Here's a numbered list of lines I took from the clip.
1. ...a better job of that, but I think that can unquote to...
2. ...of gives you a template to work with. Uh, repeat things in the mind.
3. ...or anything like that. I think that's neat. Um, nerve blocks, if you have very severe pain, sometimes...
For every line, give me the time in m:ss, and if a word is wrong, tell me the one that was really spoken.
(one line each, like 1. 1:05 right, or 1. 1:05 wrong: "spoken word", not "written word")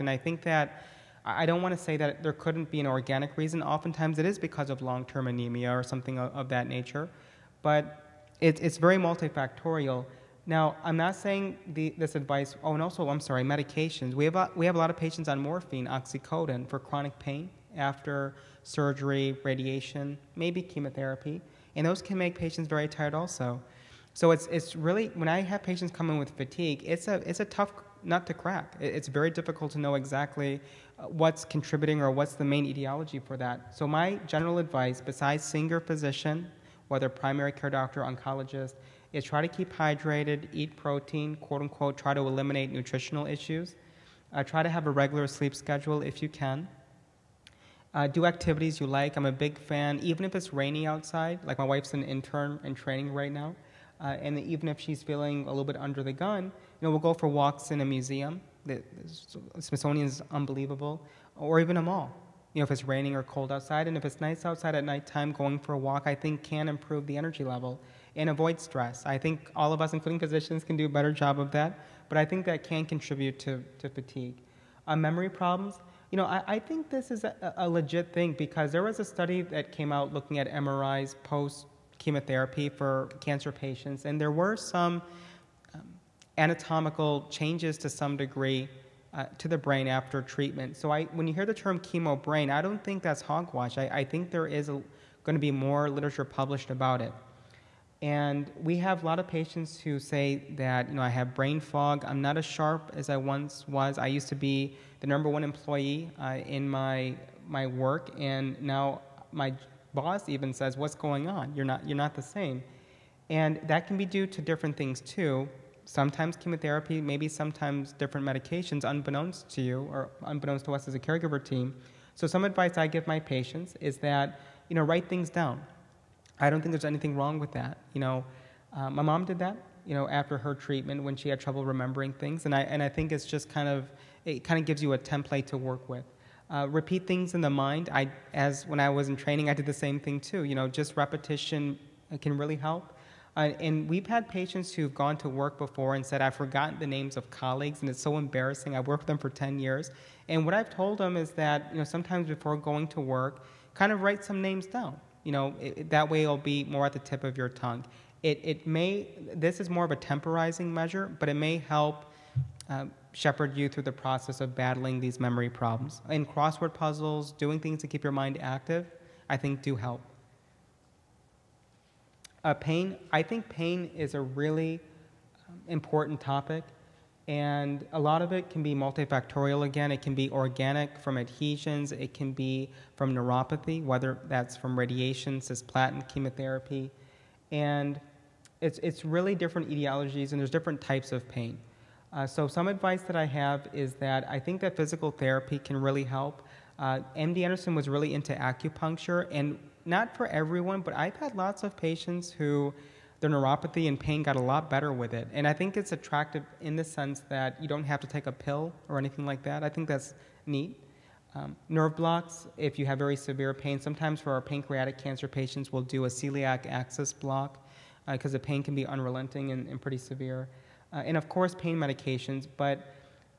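1. 1:10 wrong: "contribute", not "unquote"
2. 2:14 right
3. 3:28 right.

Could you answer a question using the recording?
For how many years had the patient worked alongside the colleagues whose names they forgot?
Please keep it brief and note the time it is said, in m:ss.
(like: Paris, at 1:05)
10, at 2:29.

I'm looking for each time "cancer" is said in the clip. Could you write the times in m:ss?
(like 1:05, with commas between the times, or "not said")
1:23, 3:34.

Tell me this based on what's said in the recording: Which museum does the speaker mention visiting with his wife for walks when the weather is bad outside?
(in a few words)
Smithsonian.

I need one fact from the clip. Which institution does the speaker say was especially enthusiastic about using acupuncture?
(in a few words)
MD Anderson.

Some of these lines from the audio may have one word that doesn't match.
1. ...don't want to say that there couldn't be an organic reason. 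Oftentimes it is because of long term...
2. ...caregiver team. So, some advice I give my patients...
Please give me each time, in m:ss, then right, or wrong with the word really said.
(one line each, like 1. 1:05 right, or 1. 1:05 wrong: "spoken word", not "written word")
1. 0:01 right
2. 2:00 right.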